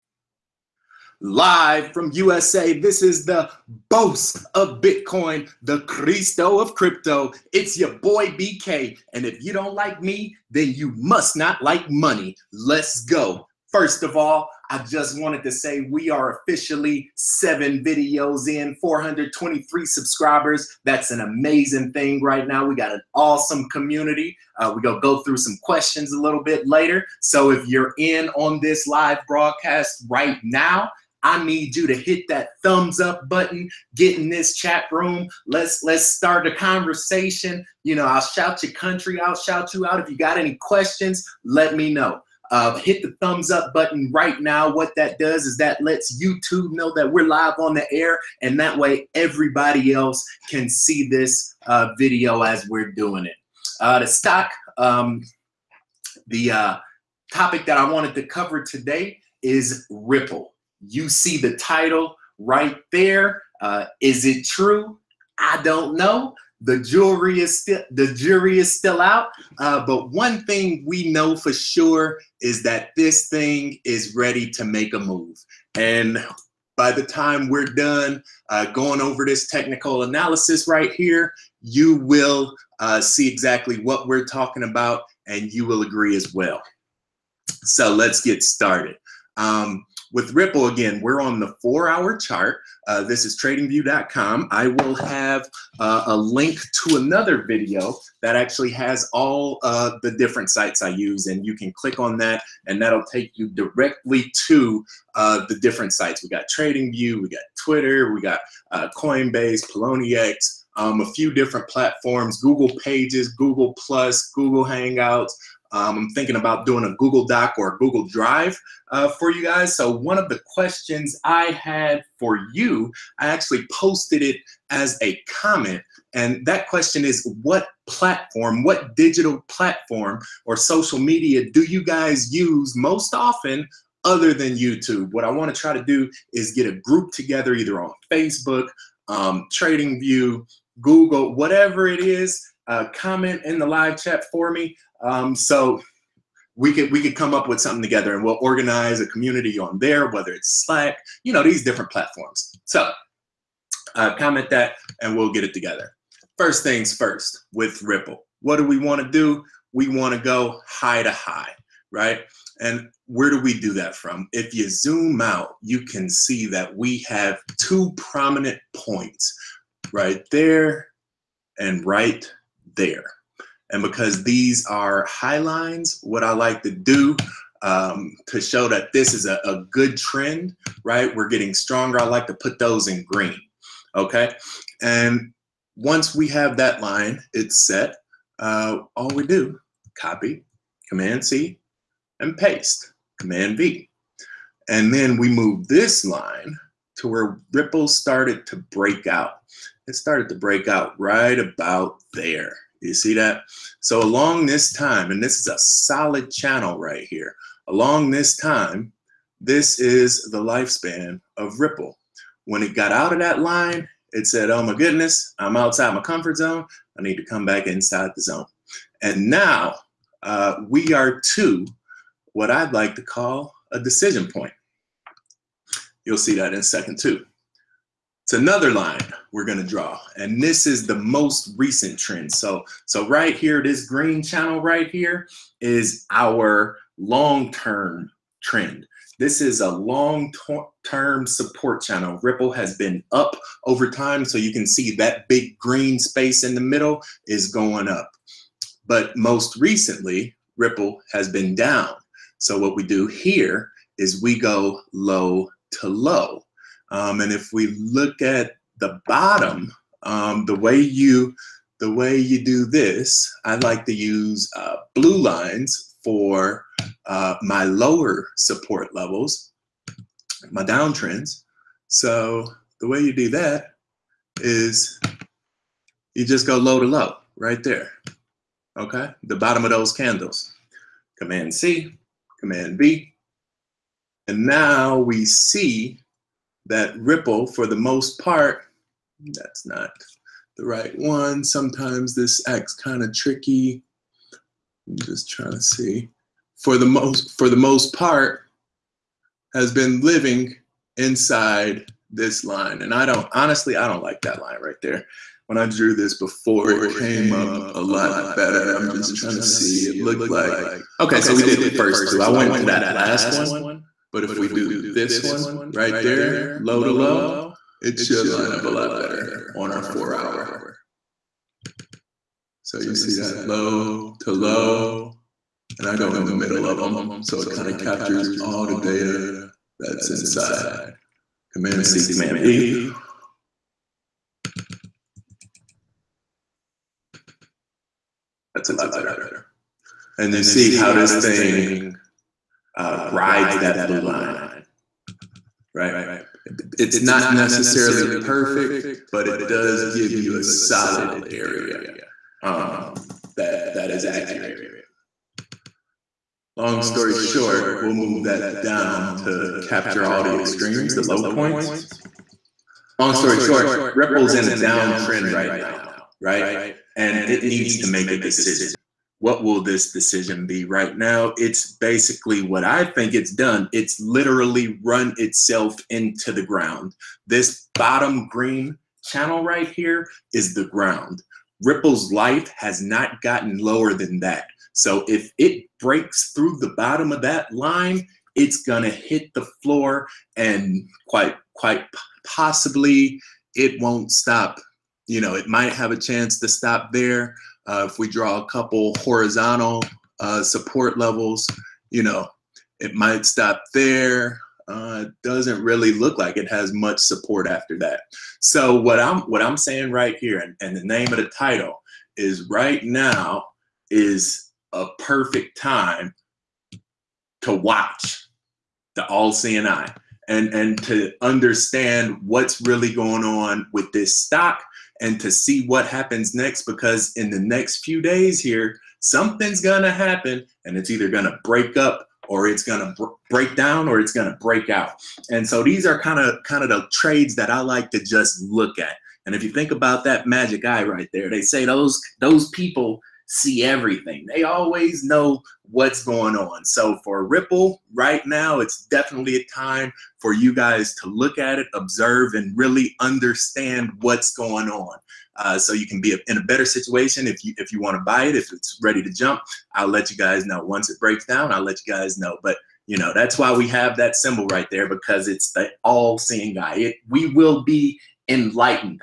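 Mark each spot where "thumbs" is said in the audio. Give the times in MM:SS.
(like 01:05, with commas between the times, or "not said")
00:32, 00:43.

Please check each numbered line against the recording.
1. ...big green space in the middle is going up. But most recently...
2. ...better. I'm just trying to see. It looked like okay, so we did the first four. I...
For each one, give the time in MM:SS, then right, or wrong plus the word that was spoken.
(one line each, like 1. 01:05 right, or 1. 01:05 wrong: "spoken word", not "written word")
1. 04:05 right
2. 05:08 wrong: "two", not "four".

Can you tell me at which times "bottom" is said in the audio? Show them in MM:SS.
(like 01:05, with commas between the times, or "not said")
04:19, 04:39, 06:17, 06:26.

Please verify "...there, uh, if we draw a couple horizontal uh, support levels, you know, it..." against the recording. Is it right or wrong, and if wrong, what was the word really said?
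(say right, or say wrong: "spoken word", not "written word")
right.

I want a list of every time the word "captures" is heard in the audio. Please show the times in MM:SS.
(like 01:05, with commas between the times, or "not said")
05:27, 05:59.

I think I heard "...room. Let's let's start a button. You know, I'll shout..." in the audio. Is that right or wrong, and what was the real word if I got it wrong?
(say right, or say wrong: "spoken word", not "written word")
wrong: "conversation", not "button".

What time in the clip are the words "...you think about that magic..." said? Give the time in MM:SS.
07:19.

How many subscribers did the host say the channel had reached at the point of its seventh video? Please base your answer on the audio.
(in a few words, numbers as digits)
423.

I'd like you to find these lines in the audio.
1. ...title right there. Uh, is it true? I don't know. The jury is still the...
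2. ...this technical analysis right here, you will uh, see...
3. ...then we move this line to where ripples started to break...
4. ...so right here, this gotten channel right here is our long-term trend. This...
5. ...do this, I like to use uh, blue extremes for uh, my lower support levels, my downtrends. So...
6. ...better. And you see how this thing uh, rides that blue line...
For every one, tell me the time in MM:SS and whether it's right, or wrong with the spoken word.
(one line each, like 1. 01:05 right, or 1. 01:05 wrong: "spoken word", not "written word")
1. 01:01 right
2. 01:19 right
3. 03:14 right
4. 03:52 wrong: "green", not "gotten"
5. 04:22 wrong: "lines", not "extremes"
6. 05:38 right.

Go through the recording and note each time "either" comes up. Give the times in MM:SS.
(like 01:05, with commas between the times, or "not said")
02:17, 07:10.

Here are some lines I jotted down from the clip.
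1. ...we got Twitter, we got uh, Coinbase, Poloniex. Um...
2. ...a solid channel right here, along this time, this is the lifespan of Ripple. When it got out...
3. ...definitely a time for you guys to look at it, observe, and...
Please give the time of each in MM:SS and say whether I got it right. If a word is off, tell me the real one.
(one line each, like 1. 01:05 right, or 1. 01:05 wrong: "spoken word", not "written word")
1. 01:47 right
2. 03:25 right
3. 07:28 right.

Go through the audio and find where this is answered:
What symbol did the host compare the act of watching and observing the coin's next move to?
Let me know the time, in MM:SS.
06:59.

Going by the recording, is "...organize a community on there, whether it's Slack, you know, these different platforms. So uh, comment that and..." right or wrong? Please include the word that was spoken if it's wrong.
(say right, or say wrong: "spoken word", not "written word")
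right.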